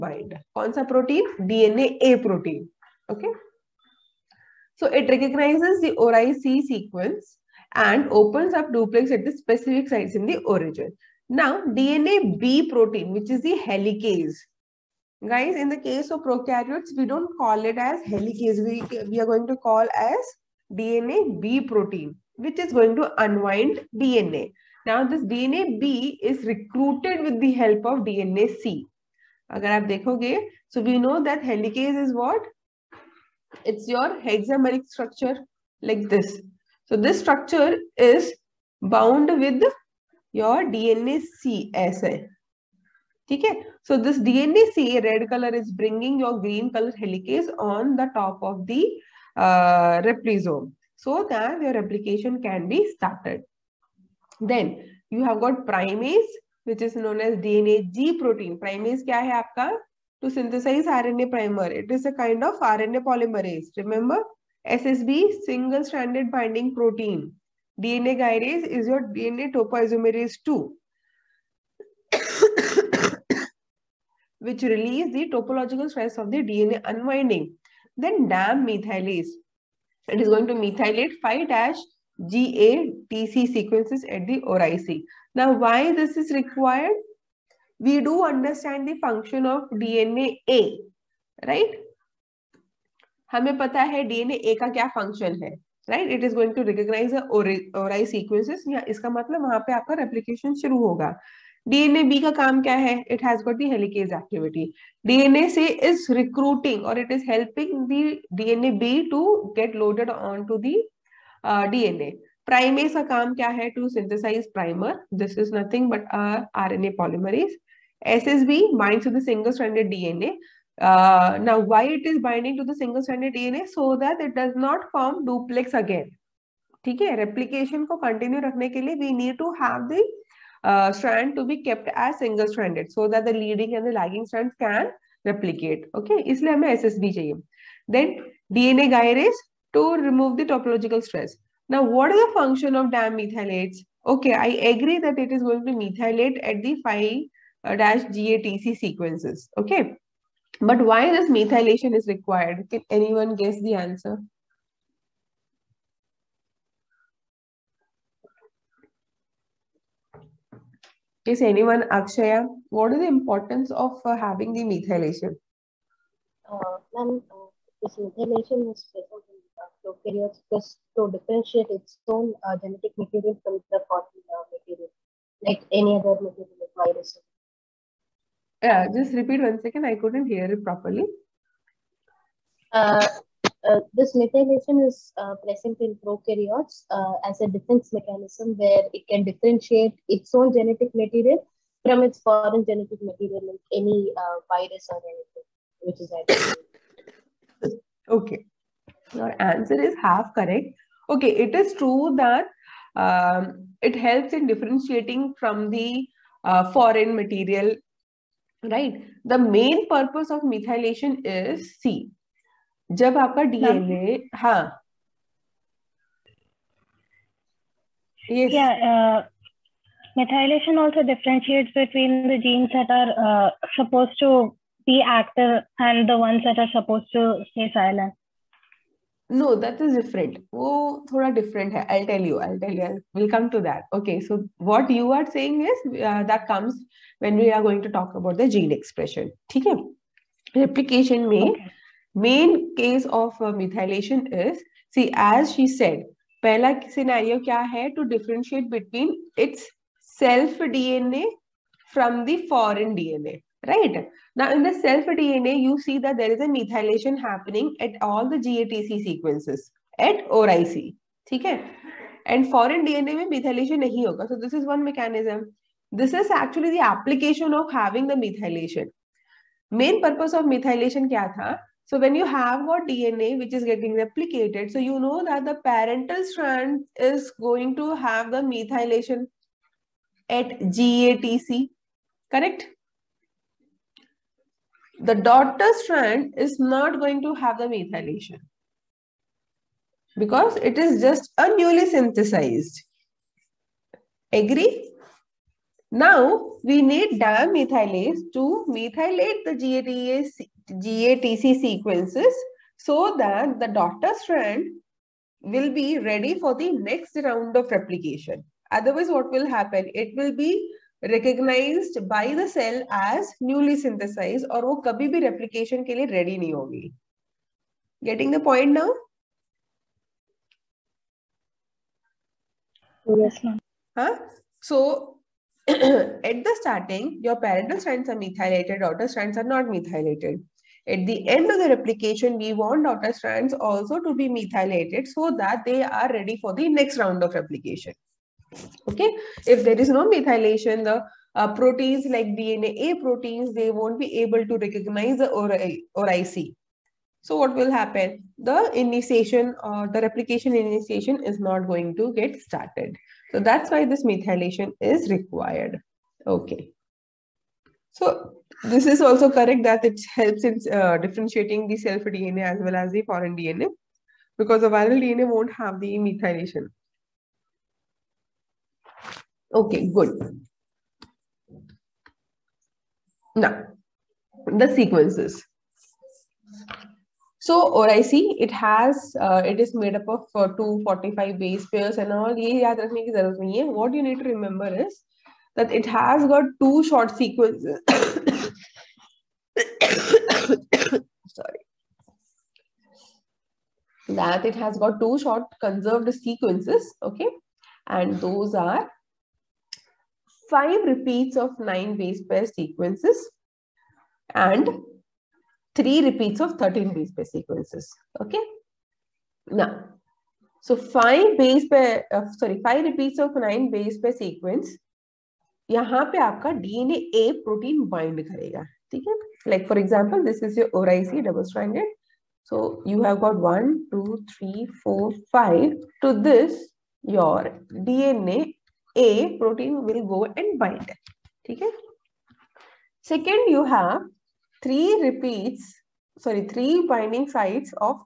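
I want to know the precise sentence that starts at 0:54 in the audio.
Then you have got primase which is known as DNA G protein.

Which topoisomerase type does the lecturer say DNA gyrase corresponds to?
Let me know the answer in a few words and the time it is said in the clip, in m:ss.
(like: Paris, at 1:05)
Topoisomerase 2, at 1:09.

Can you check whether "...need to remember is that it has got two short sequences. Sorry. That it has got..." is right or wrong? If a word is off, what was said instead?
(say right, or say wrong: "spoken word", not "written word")
right.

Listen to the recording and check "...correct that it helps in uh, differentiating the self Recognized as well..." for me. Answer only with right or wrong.
wrong.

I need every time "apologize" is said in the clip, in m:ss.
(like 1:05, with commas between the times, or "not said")
not said.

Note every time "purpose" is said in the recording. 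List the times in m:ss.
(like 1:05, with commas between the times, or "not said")
3:29, 4:30.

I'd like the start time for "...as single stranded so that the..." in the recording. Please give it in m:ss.
2:11.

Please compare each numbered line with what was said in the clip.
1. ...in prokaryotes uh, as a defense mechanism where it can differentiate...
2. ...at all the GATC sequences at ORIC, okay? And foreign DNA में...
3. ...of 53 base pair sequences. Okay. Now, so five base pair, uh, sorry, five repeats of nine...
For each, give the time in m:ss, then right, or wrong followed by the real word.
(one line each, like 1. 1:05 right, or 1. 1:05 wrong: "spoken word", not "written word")
1. 3:05 right
2. 4:17 right
3. 6:46 wrong: "13", not "53".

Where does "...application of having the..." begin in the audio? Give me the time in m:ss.
4:26.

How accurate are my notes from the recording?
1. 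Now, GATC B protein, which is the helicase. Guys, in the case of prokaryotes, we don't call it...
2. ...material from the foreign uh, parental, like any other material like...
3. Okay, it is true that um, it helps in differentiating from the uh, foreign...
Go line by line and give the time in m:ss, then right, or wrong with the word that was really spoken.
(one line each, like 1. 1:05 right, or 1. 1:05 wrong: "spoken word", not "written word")
1. 0:11 wrong: "DNA", not "GATC"
2. 2:52 wrong: "material", not "parental"
3. 3:21 right.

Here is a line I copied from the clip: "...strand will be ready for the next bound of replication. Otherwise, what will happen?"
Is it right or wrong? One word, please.
wrong.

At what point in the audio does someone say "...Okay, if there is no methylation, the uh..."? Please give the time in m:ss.
5:38.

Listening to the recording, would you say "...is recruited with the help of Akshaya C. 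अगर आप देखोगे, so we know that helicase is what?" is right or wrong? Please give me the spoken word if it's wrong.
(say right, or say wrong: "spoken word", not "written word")
wrong: "DNA", not "Akshaya".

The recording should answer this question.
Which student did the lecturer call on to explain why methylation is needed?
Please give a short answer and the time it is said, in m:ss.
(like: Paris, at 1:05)
Akshaya, at 2:41.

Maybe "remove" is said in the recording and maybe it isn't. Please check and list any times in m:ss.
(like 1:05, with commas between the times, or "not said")
2:19.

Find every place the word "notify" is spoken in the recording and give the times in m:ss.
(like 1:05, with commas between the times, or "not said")
not said.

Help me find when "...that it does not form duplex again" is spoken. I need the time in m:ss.
2:03.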